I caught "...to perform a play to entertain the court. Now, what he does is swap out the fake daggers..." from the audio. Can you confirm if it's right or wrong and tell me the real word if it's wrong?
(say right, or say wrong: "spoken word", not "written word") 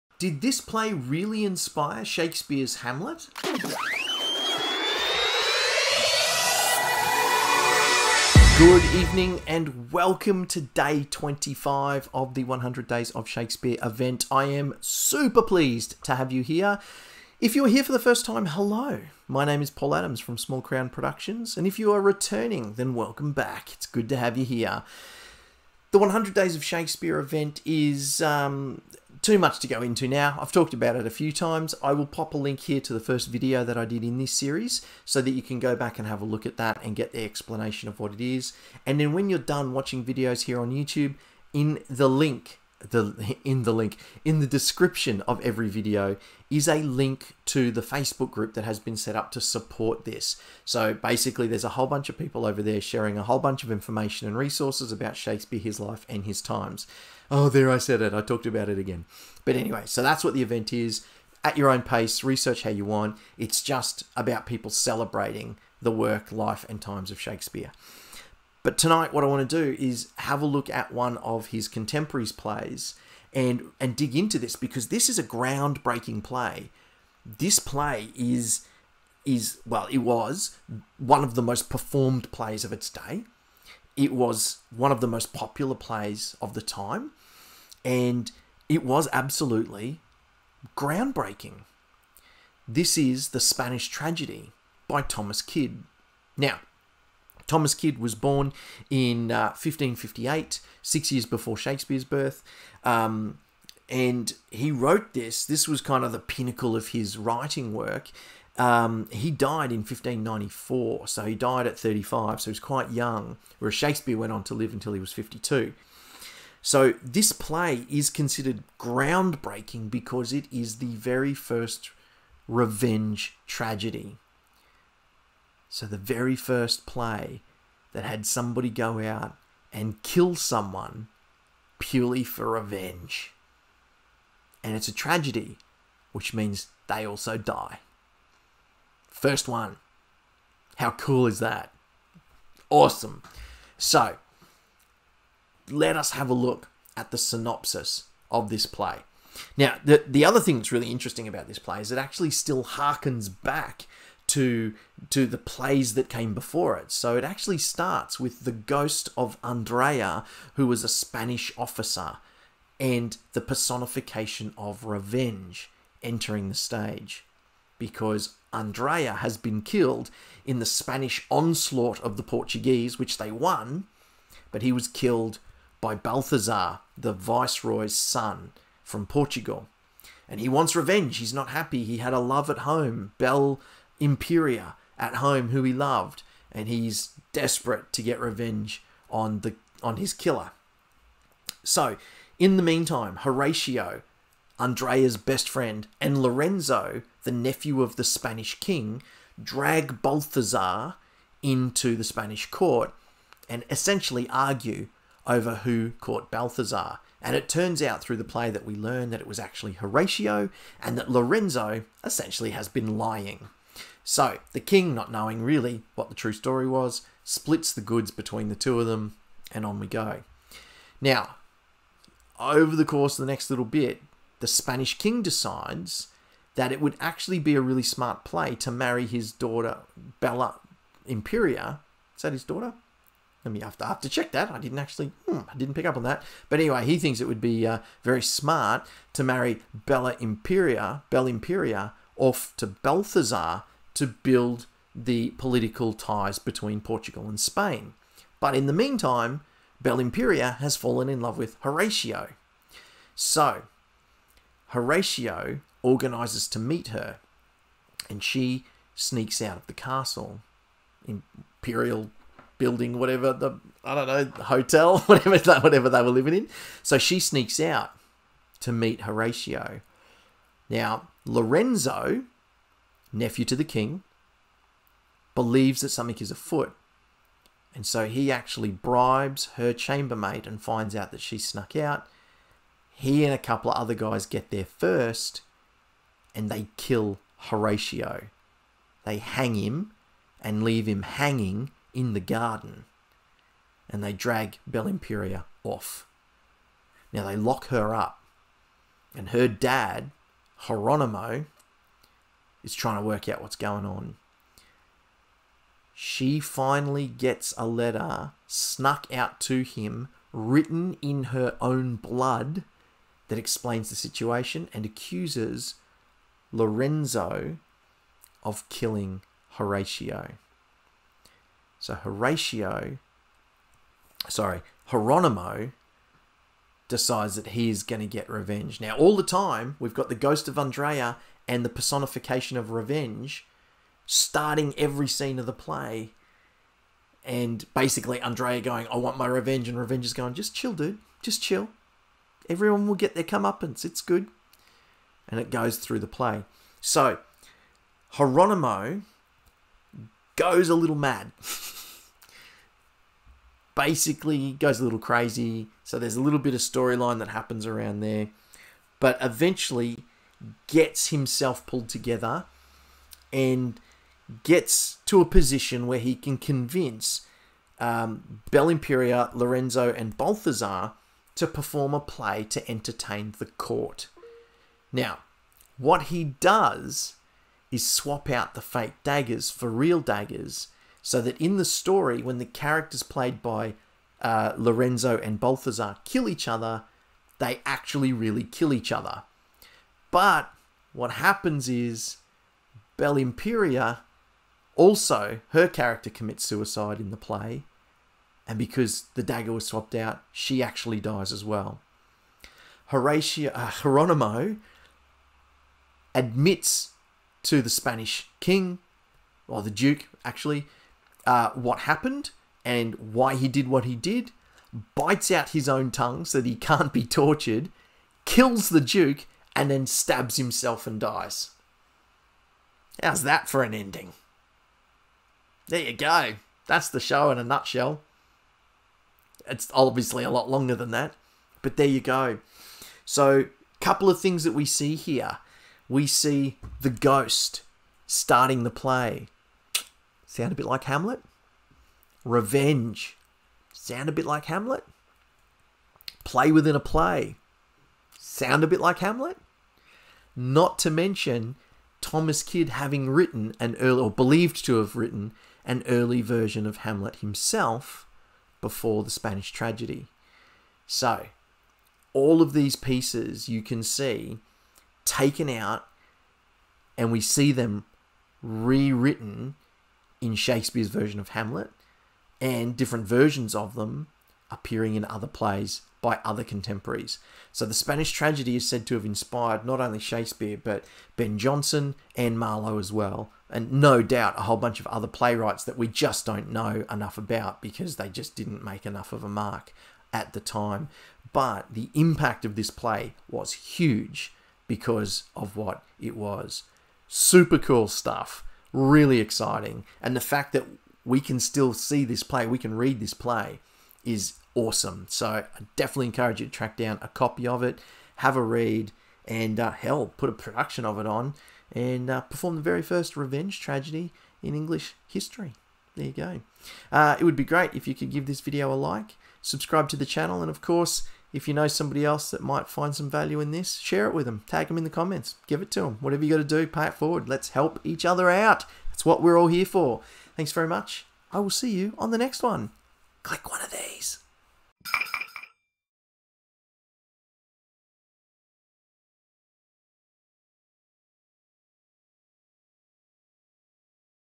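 right.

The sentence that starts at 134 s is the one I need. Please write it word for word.
And it's a tragedy, which means they also die.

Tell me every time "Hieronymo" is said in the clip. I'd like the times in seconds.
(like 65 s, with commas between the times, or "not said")
300 s, 324 s, 348 s.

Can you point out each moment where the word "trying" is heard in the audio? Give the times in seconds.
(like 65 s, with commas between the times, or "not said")
302 s.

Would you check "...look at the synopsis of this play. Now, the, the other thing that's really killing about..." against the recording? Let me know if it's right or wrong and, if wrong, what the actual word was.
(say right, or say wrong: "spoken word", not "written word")
wrong: "interesting", not "killing".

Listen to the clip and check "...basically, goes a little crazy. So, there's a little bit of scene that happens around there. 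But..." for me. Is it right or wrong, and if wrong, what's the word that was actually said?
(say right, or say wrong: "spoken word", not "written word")
wrong: "storyline", not "scene".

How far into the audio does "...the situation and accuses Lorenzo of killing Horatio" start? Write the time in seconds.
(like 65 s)
313 s.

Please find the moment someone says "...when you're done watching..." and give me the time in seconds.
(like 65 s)
39 s.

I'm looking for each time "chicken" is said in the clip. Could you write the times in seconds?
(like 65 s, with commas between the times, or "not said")
not said.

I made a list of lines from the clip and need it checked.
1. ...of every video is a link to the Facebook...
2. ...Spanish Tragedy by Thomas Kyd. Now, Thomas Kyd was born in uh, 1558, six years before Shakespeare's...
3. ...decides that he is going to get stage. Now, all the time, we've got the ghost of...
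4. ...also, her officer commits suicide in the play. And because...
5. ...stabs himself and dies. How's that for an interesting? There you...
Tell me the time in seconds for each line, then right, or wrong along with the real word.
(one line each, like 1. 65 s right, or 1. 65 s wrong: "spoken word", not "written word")
1. 45 s right
2. 93 s right
3. 326 s wrong: "revenge", not "stage"
4. 394 s wrong: "character", not "officer"
5. 419 s wrong: "ending", not "interesting".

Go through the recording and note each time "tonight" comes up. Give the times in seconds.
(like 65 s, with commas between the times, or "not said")
68 s.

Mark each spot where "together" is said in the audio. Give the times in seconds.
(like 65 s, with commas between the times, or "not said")
361 s.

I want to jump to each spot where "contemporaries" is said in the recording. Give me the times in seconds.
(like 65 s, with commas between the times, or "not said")
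71 s, 476 s.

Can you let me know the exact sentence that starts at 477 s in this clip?
So the Spanish tragedy is said to have inspired not only Shakespeare, but Ben Jonson and Marlowe as well.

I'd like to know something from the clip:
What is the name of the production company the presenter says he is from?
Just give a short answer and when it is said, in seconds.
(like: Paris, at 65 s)
Small Crown Productions, at 20 s.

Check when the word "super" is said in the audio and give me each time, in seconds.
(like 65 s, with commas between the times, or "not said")
14 s, 497 s.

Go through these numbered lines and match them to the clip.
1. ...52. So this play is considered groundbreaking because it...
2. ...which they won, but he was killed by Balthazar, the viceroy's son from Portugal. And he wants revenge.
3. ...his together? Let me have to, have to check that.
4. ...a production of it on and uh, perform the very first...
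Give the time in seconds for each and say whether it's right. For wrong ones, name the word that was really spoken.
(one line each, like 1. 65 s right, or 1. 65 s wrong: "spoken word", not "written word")
1. 115 s right
2. 172 s right
3. 232 s wrong: "daughter", not "together"
4. 510 s right.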